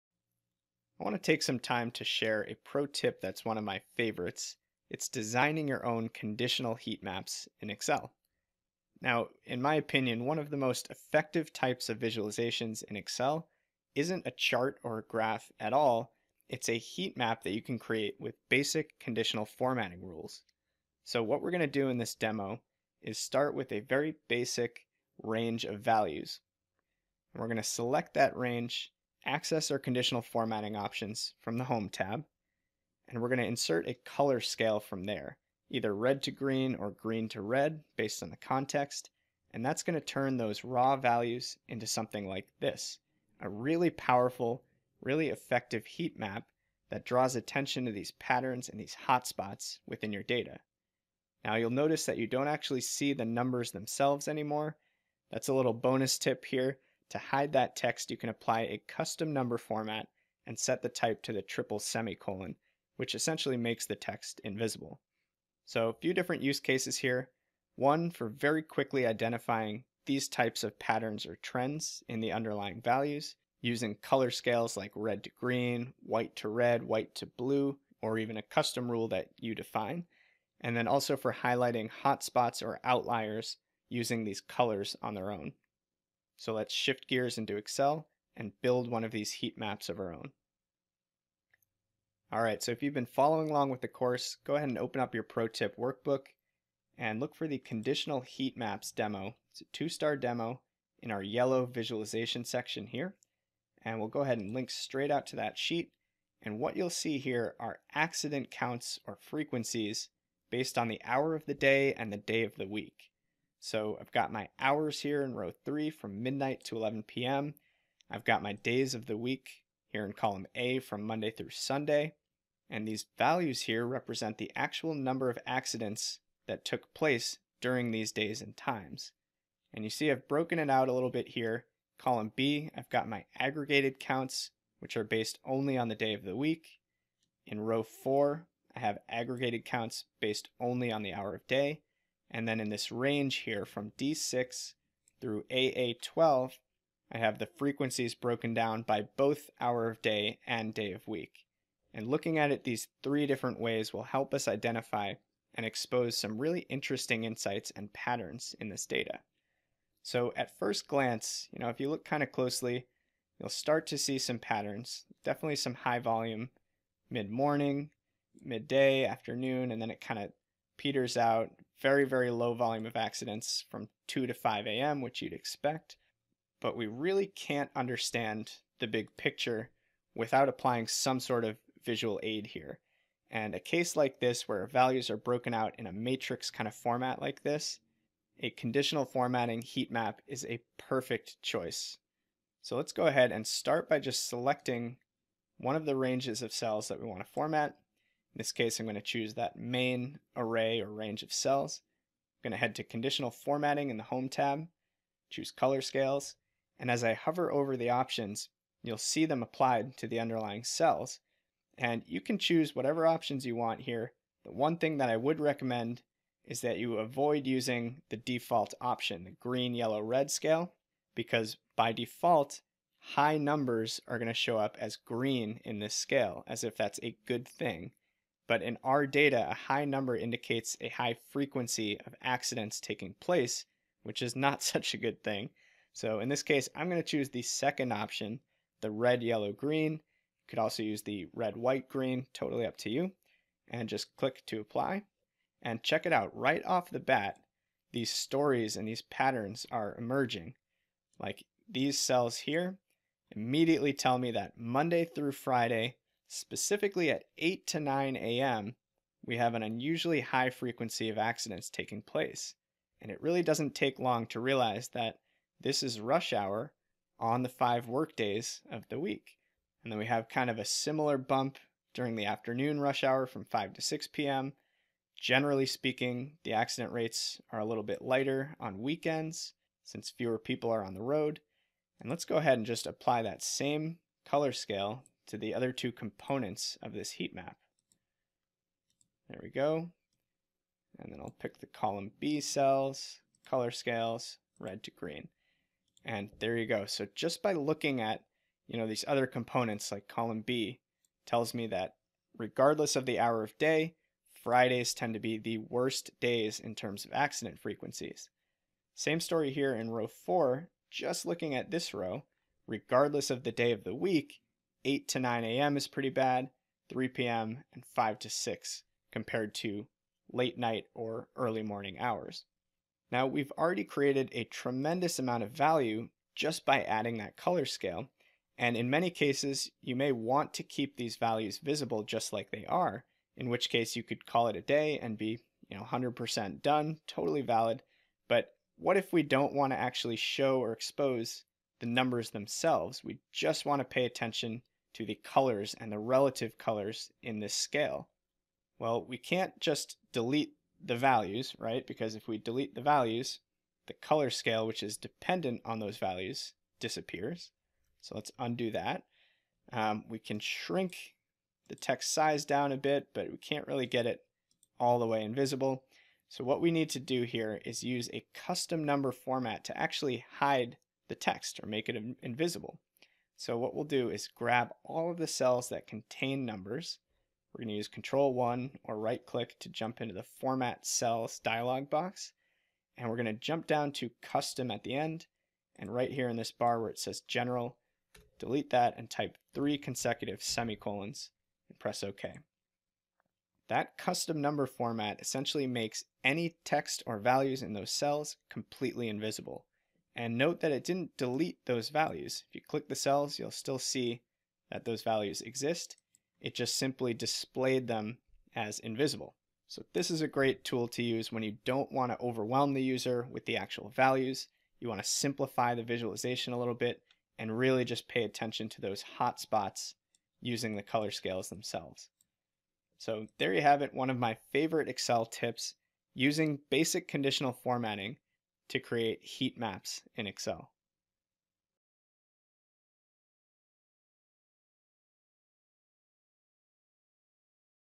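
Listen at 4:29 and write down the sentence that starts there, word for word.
And then we have kind of a similar bump during the afternoon rush hour from 5 to 6 p.m.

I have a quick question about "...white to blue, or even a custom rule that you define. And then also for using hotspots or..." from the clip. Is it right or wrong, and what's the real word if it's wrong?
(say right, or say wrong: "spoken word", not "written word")
wrong: "highlighting", not "using".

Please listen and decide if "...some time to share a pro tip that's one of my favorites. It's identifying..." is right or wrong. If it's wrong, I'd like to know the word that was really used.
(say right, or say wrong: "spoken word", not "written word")
wrong: "designing", not "identifying".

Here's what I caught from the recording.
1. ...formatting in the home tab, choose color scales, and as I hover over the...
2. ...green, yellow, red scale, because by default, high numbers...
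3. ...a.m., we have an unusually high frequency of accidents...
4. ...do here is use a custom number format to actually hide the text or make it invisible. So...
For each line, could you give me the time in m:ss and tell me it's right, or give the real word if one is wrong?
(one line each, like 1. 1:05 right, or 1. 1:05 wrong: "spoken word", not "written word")
1. 3:23 right
2. 3:39 right
3. 4:18 right
4. 6:06 right.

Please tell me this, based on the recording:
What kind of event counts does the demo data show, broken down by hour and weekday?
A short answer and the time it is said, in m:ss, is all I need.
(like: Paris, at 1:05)
accident counts, at 1:47.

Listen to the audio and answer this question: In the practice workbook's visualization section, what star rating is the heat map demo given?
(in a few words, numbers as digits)
two-star.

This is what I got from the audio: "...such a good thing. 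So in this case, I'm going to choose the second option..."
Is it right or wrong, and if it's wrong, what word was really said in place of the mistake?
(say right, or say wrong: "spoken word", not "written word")
right.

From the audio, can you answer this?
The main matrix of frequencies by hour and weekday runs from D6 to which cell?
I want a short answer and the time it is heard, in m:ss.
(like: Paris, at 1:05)
AA12, at 2:25.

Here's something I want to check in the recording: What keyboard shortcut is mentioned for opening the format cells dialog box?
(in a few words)
Control 1.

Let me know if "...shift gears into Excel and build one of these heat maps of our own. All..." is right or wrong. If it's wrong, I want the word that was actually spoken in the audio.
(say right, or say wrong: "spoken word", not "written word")
right.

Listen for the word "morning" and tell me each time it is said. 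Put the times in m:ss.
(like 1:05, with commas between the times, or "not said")
2:47, 5:21.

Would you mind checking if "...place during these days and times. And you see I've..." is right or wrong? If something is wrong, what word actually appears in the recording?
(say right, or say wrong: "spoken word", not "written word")
right.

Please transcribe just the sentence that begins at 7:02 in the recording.
So there you have it, one of my favorite Excel tips using basic conditional formatting to create heat maps in Excel.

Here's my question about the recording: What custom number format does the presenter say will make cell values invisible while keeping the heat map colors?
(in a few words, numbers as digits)
triple semicolon.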